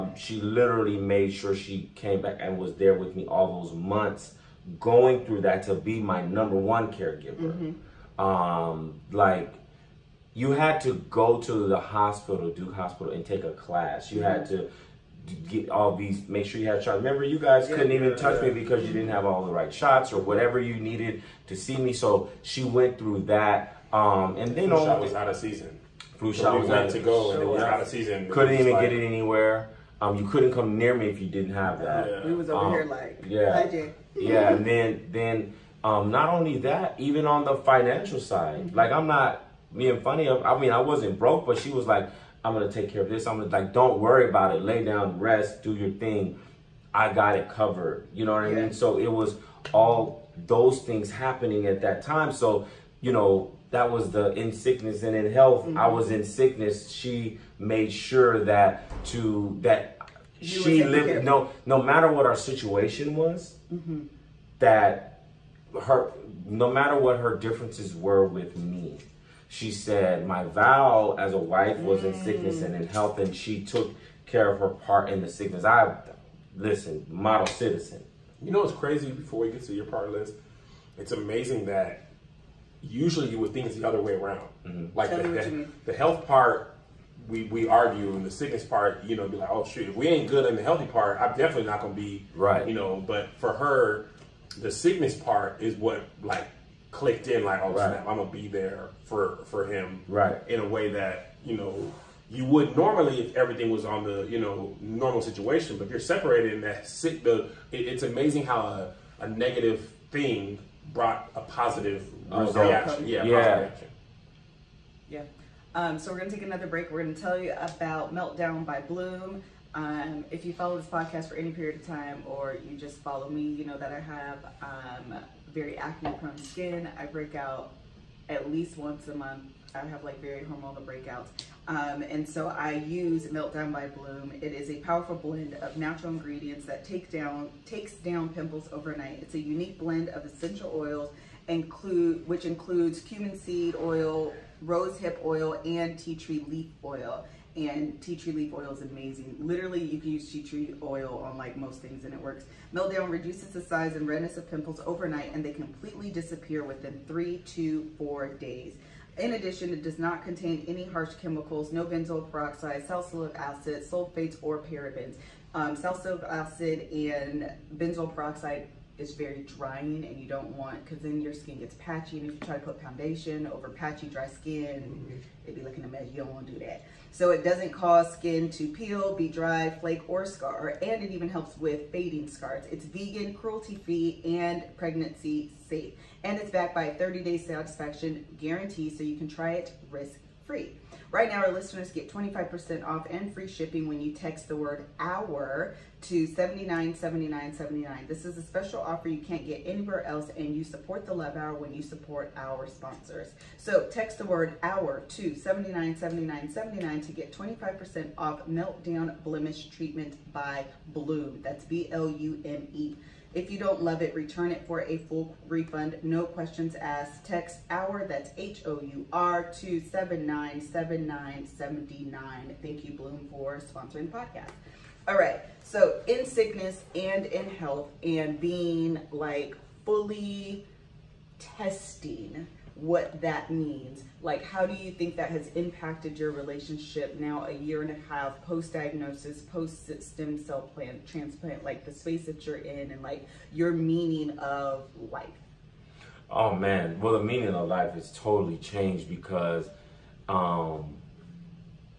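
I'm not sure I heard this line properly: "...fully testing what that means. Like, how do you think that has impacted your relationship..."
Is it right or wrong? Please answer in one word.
right.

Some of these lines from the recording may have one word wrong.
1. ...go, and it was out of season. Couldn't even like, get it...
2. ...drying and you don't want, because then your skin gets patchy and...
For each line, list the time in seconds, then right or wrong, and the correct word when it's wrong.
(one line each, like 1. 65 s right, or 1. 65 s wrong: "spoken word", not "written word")
1. 26 s right
2. 169 s right.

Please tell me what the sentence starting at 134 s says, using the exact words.
It is a powerful blend of natural ingredients that take down takes down pimples overnight.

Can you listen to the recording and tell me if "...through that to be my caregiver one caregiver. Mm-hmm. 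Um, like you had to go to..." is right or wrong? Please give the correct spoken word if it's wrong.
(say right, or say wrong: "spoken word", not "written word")
wrong: "number", not "caregiver".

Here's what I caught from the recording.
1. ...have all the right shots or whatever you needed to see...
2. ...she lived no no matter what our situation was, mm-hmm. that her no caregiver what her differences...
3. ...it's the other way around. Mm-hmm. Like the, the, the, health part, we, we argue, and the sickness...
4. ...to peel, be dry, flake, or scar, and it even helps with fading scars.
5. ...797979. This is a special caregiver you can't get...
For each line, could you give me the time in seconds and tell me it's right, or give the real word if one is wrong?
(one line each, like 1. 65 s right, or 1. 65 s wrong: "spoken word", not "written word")
1. 19 s right
2. 60 s wrong: "matter", not "caregiver"
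3. 83 s right
4. 178 s right
5. 196 s wrong: "offer", not "caregiver".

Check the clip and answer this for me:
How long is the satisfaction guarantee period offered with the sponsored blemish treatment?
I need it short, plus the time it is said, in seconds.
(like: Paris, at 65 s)
30 days, at 186 s.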